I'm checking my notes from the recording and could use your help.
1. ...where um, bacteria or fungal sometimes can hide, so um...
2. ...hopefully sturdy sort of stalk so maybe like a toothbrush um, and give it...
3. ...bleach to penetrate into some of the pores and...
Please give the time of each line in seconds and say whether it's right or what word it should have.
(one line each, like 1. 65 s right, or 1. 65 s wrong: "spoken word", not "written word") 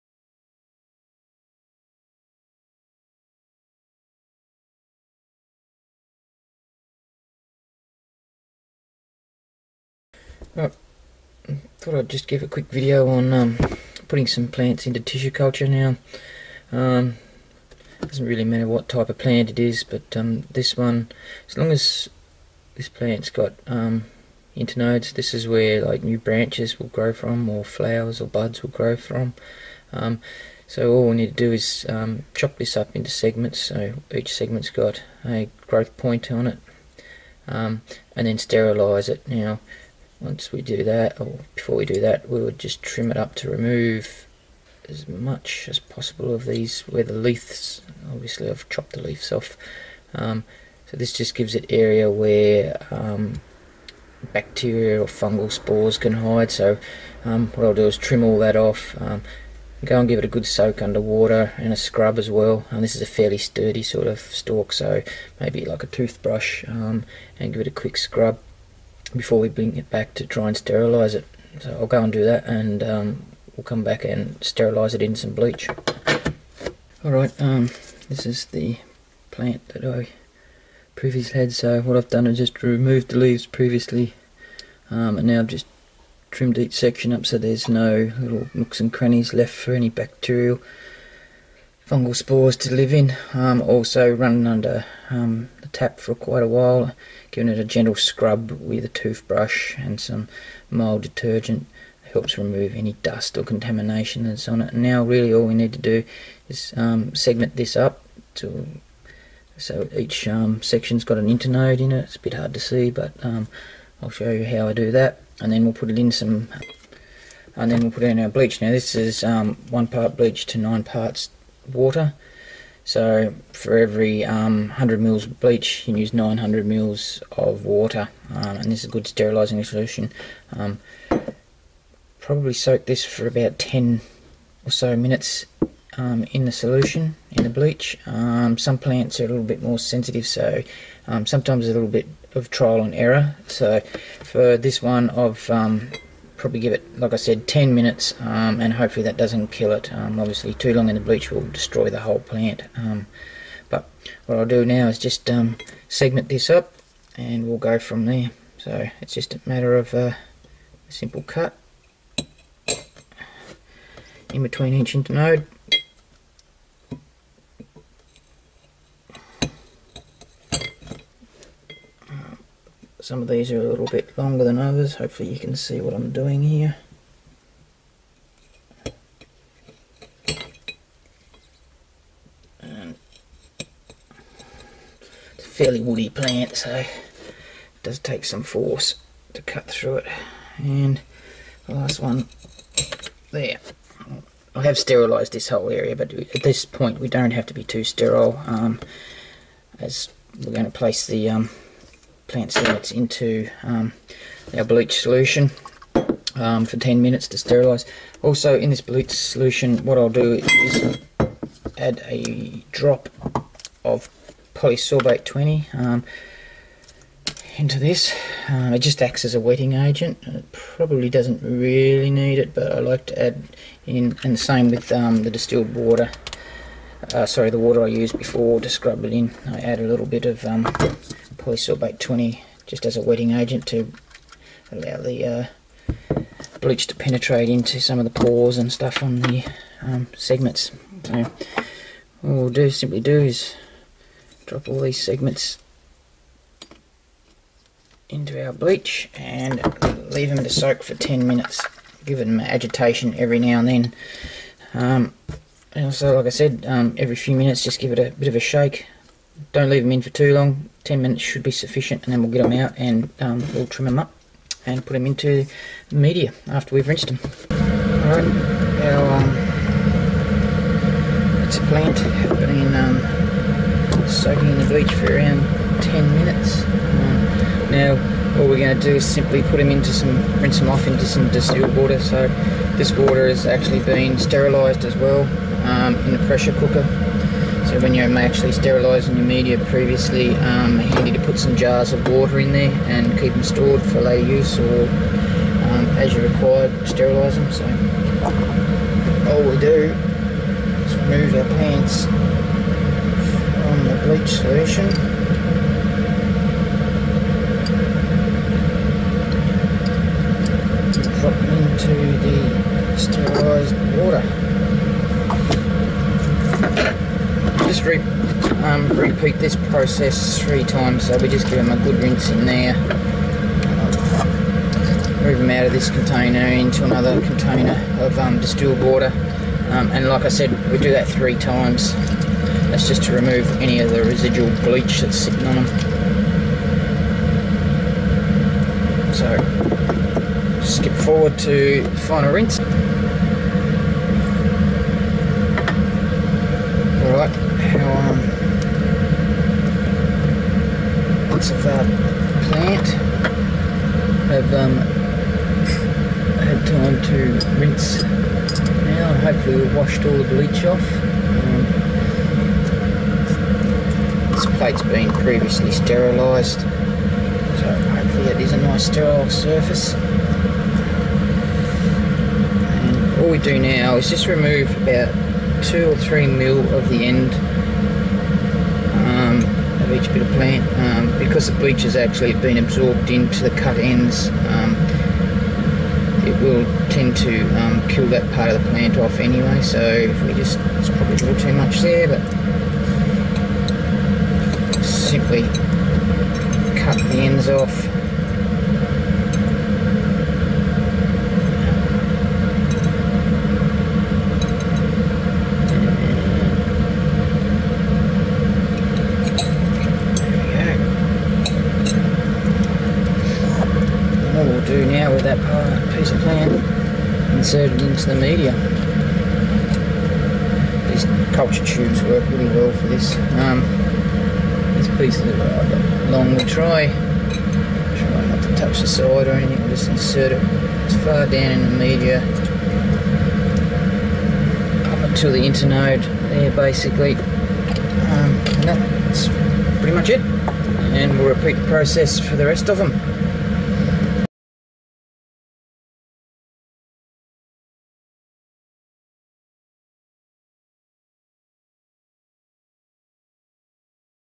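1. 52 s wrong: "spores", not "sometimes"
2. 63 s wrong: "fairly", not "hopefully"
3. 236 s right.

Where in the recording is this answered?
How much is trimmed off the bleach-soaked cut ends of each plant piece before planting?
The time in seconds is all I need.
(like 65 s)
375 s.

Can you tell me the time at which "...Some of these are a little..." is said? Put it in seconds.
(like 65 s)
173 s.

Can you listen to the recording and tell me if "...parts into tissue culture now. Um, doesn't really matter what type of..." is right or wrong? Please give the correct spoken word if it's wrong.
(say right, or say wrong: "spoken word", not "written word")
wrong: "plants", not "parts".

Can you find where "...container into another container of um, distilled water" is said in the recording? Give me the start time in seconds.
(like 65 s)
325 s.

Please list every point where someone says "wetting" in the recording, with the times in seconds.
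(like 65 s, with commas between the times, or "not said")
219 s, 233 s.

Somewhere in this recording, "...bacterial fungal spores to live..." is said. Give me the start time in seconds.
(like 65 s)
89 s.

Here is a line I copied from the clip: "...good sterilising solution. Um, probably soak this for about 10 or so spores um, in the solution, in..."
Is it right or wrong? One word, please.
wrong.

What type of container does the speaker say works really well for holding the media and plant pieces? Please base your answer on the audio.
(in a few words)
culture tubes.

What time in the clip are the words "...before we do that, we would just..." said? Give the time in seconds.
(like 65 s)
41 s.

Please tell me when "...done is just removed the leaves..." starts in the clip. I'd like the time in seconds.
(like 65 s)
82 s.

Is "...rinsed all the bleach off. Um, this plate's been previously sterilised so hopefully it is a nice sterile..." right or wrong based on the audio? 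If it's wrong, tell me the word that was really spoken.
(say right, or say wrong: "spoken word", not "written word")
wrong: "washed", not "rinsed".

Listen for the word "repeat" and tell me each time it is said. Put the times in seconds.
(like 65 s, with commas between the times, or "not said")
318 s, 441 s.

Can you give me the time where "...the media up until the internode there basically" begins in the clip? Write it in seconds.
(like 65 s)
431 s.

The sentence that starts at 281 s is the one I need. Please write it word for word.
So this water has actually been sterilised as well um, in the pressure cooker.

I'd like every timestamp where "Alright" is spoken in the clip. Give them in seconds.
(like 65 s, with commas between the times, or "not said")
77 s, 268 s.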